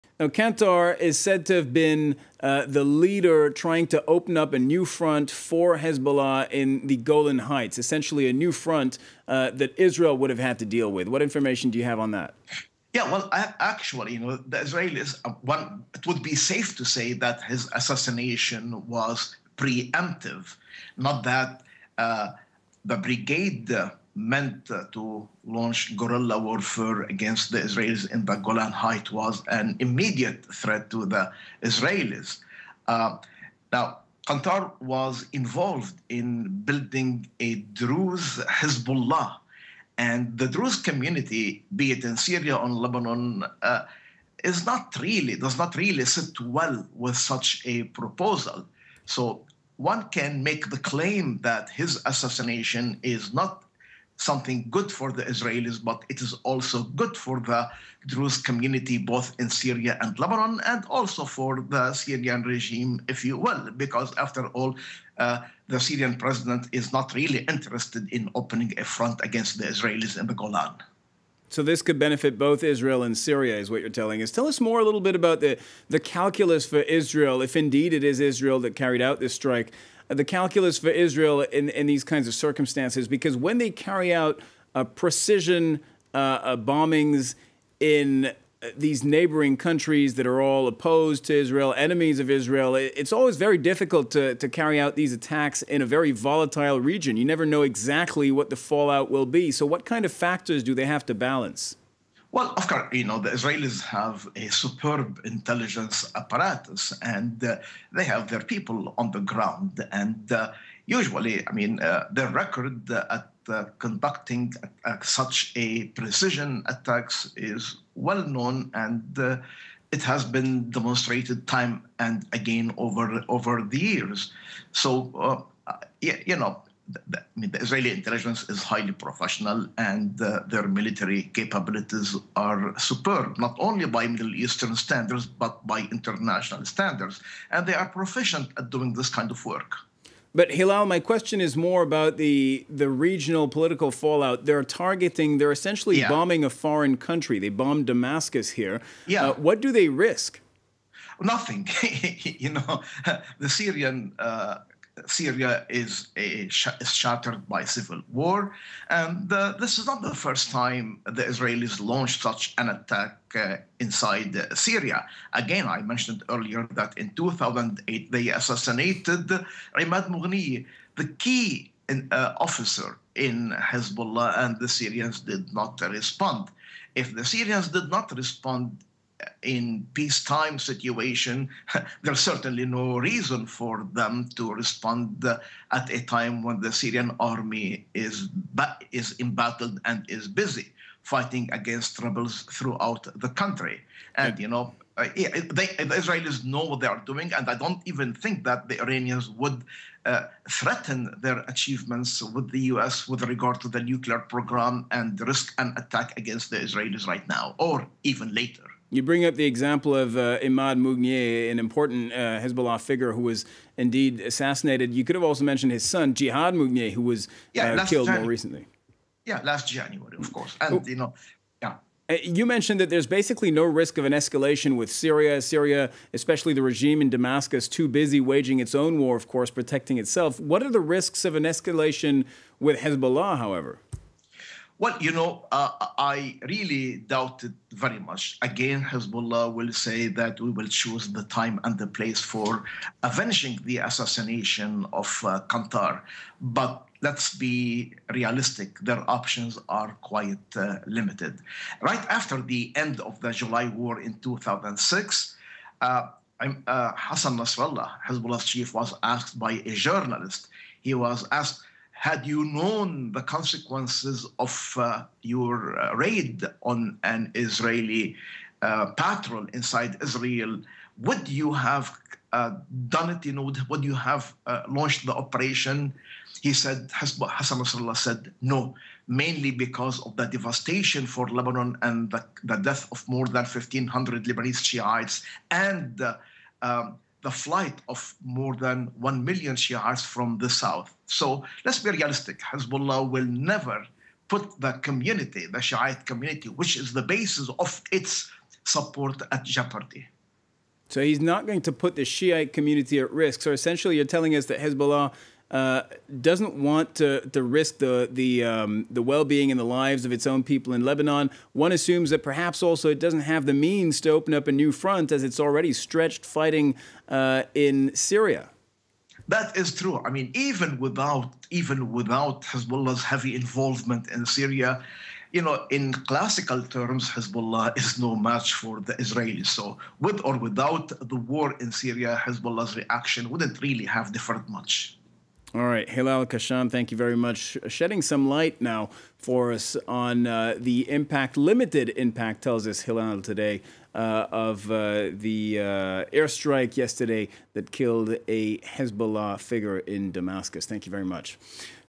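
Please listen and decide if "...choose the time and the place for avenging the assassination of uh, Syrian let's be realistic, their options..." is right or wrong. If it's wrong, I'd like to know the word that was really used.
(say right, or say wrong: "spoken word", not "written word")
wrong: "But", not "Syrian".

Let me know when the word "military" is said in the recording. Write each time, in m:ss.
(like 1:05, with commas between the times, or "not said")
2:10.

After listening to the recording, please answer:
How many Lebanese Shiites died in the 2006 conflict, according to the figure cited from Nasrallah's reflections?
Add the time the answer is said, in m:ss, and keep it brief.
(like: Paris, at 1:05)
more than 1,500, at 4:43.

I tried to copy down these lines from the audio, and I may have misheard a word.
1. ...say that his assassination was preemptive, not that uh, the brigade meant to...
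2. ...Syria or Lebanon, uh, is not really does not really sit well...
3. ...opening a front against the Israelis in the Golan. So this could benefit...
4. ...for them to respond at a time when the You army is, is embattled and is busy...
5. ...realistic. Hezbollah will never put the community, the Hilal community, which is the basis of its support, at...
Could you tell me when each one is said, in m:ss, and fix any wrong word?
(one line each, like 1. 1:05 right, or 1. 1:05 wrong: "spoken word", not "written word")
1. 0:16 right
2. 0:42 right
3. 1:08 right
4. 3:03 wrong: "Syrian", not "You"
5. 4:51 wrong: "Shiite", not "Hilal".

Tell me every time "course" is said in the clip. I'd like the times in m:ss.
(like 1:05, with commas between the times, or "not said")
1:42, 3:40, 3:49.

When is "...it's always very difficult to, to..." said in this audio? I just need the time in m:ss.
1:32.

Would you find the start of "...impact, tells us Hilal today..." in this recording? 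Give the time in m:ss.
5:41.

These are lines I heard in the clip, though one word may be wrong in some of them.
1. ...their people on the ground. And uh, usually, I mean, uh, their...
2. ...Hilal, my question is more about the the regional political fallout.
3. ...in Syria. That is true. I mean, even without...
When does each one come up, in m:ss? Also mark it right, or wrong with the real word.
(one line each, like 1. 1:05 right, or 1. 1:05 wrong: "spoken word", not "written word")
1. 1:48 right
2. 2:20 right
3. 5:17 right.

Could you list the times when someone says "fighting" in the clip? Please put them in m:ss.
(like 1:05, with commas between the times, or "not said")
3:11, 5:16.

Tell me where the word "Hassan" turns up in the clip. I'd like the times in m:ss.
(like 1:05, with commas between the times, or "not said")
4:16, 4:36.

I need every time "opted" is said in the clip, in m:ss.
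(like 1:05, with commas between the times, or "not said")
not said.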